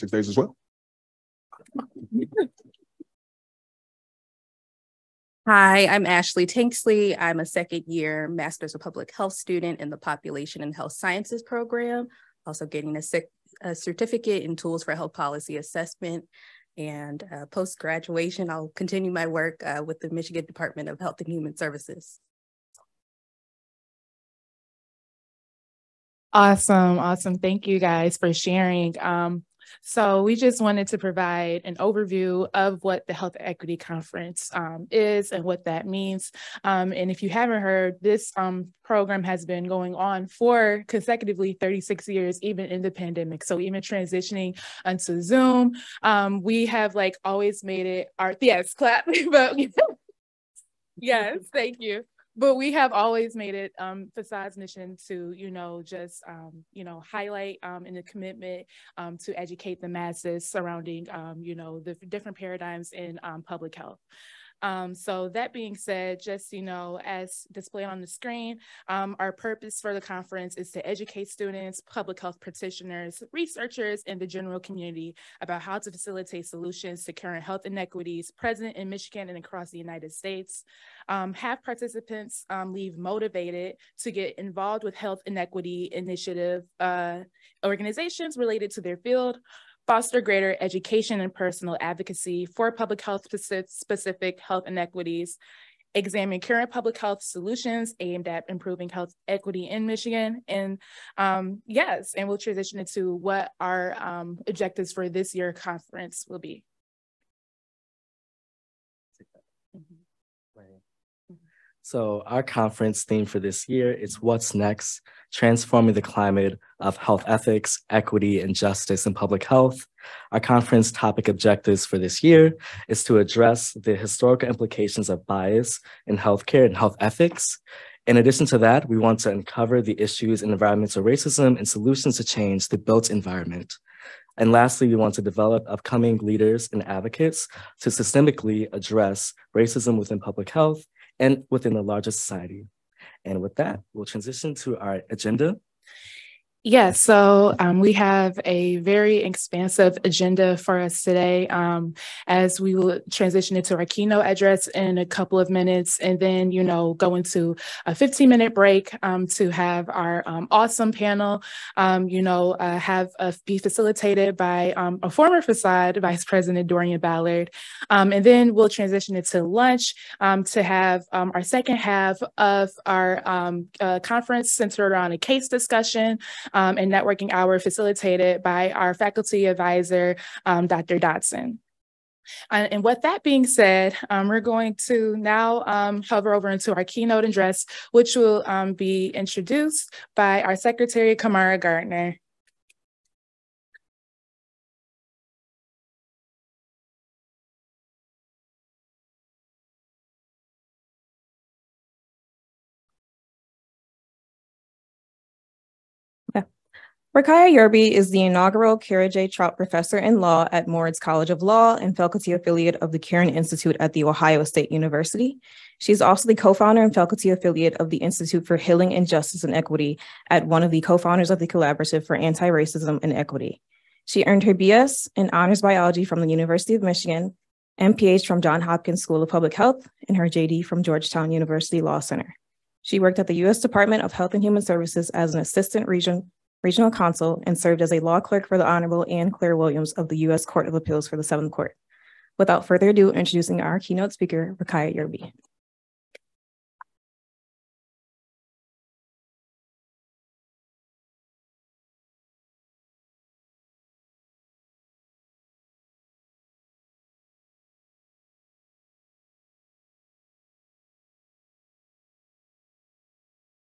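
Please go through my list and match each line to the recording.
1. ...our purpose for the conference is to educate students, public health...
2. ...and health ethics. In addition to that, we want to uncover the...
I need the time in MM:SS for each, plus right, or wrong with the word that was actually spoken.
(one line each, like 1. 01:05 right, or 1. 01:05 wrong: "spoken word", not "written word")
1. 01:09 right
2. 02:06 right.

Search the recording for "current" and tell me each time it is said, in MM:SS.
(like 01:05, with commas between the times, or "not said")
01:17, 01:36.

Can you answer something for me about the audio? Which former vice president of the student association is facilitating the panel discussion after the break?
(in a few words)
Dorian Ballard.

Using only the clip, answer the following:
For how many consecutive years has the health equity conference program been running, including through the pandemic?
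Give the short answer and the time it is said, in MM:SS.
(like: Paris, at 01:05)
36, at 00:41.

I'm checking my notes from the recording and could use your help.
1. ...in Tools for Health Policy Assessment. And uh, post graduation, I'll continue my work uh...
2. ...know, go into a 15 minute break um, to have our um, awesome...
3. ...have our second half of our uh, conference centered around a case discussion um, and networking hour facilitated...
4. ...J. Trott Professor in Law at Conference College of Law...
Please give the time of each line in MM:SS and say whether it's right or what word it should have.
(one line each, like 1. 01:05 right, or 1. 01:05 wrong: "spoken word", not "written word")
1. 00:14 right
2. 02:36 right
3. 02:50 right
4. 03:29 wrong: "Moritz", not "Conference".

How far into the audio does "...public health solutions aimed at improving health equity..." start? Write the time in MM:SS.
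01:36.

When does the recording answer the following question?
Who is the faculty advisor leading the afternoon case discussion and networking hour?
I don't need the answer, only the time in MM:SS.
03:00.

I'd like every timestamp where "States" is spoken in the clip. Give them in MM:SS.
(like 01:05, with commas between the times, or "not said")
01:20, 03:34.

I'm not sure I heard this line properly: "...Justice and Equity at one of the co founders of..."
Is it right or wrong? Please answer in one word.
right.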